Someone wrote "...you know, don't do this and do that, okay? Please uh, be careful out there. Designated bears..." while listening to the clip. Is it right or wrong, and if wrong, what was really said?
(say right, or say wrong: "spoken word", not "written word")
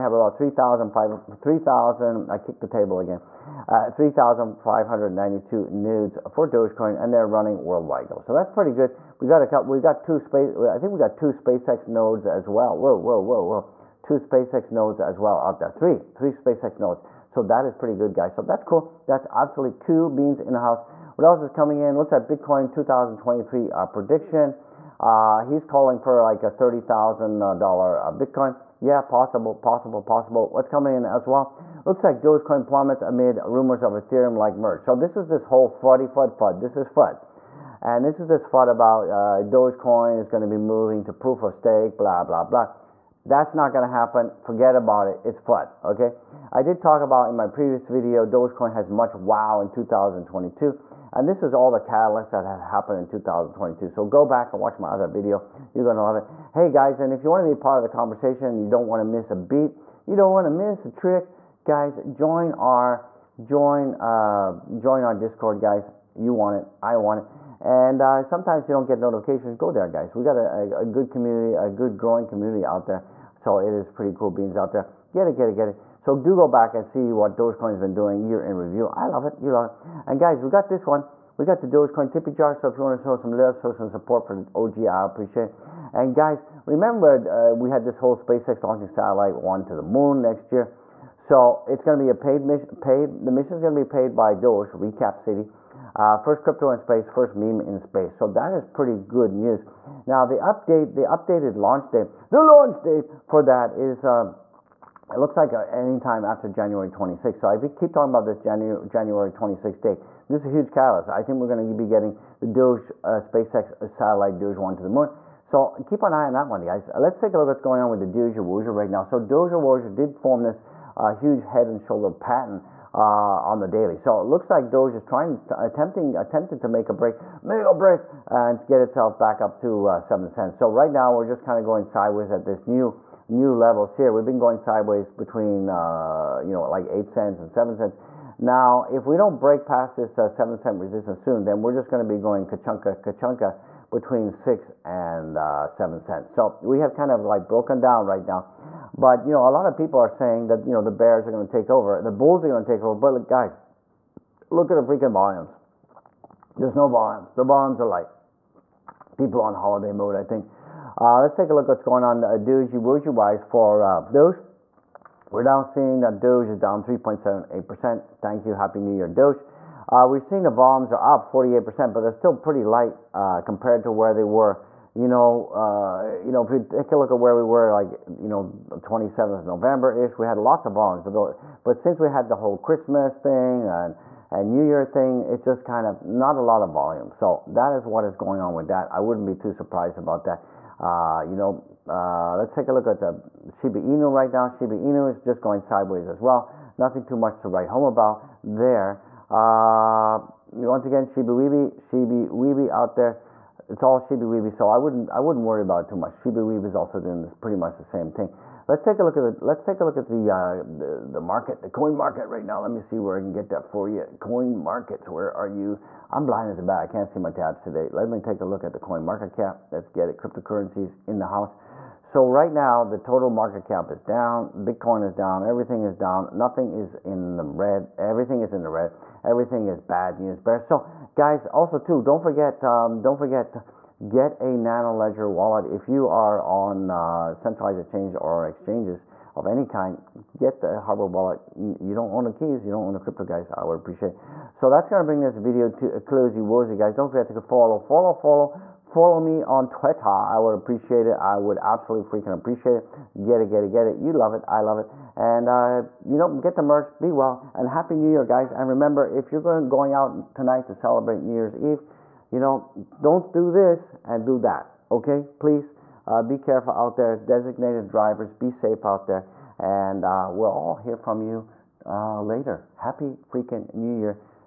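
wrong: "drivers", not "bears".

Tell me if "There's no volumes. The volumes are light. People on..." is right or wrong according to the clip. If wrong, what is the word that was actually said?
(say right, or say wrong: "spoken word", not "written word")
right.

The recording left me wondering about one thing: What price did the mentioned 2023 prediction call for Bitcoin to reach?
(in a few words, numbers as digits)
$30,000.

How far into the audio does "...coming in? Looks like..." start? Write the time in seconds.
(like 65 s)
21 s.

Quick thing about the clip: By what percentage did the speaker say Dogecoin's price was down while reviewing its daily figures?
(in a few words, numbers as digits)
3.78%.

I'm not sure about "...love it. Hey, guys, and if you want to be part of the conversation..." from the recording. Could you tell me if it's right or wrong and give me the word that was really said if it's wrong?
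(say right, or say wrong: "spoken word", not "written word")
right.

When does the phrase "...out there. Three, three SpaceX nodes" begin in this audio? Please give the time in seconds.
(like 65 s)
15 s.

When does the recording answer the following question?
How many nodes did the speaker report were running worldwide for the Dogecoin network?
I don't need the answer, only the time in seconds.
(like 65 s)
3 s.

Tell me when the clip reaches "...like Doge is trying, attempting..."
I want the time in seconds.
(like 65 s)
124 s.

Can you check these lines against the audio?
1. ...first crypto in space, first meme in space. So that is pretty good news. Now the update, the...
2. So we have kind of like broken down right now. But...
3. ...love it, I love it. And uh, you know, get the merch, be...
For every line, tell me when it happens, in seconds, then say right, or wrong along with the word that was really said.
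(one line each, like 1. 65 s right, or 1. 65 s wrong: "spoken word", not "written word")
1. 96 s right
2. 146 s right
3. 254 s right.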